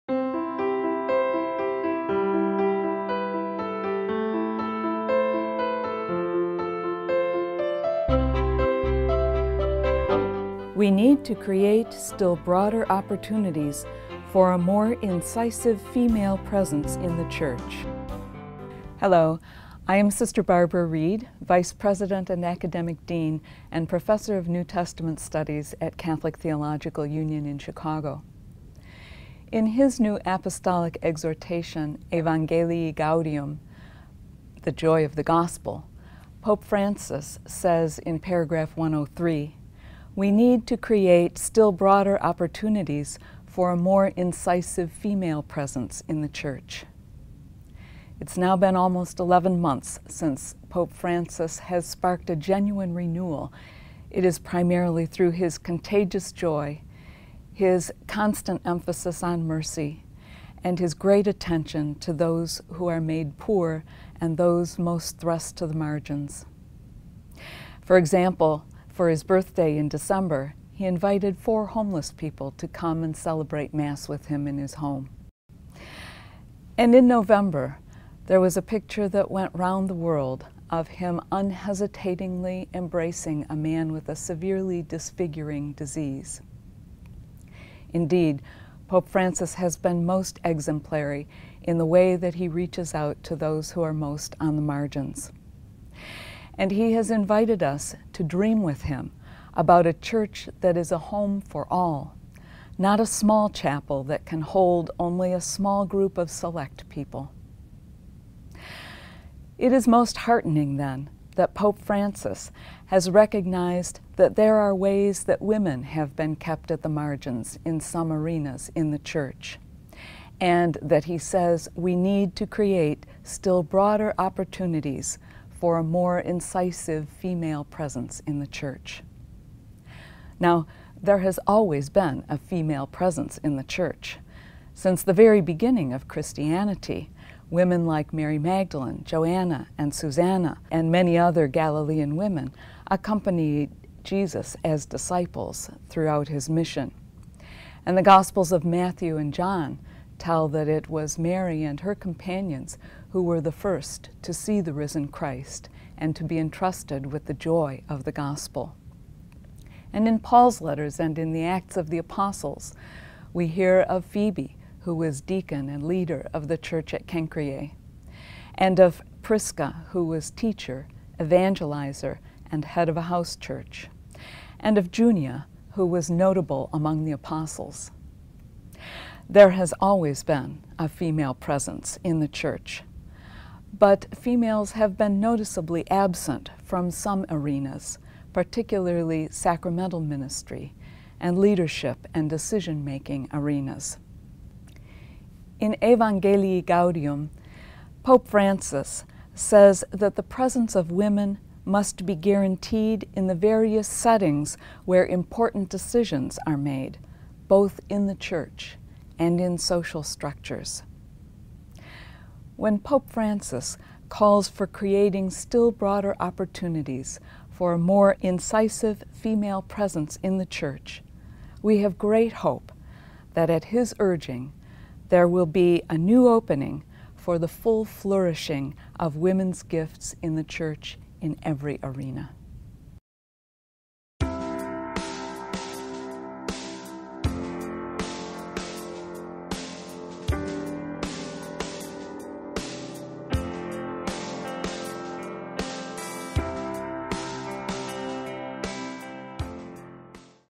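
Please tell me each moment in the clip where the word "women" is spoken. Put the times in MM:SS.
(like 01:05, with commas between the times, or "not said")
01:55, 02:17, 02:22, 03:20, 03:49.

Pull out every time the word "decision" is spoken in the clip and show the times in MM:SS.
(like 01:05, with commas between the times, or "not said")
03:12, 03:25.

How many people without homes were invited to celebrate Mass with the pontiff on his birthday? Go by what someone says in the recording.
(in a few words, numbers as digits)
4.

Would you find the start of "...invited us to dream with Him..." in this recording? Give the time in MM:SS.
01:37.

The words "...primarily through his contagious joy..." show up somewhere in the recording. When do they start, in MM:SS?
00:54.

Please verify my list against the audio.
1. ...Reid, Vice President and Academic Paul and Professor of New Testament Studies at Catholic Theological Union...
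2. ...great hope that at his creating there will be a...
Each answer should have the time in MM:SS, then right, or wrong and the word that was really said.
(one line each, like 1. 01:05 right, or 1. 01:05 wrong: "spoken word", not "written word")
1. 00:20 wrong: "Dean", not "Paul"
2. 03:41 wrong: "urging", not "creating".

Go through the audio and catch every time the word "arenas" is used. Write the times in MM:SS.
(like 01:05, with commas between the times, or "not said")
01:58, 03:07, 03:13, 03:51.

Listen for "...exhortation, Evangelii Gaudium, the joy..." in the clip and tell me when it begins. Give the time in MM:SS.
00:31.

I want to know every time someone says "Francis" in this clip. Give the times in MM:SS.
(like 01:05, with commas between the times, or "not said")
00:36, 00:50, 01:29, 01:51, 03:18, 03:33.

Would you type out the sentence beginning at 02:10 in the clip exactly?
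Now, there has always been a female presence in the church.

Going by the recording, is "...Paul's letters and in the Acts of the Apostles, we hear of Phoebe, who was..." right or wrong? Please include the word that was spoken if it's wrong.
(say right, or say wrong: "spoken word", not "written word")
right.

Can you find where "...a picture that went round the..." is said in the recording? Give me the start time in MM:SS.
01:18.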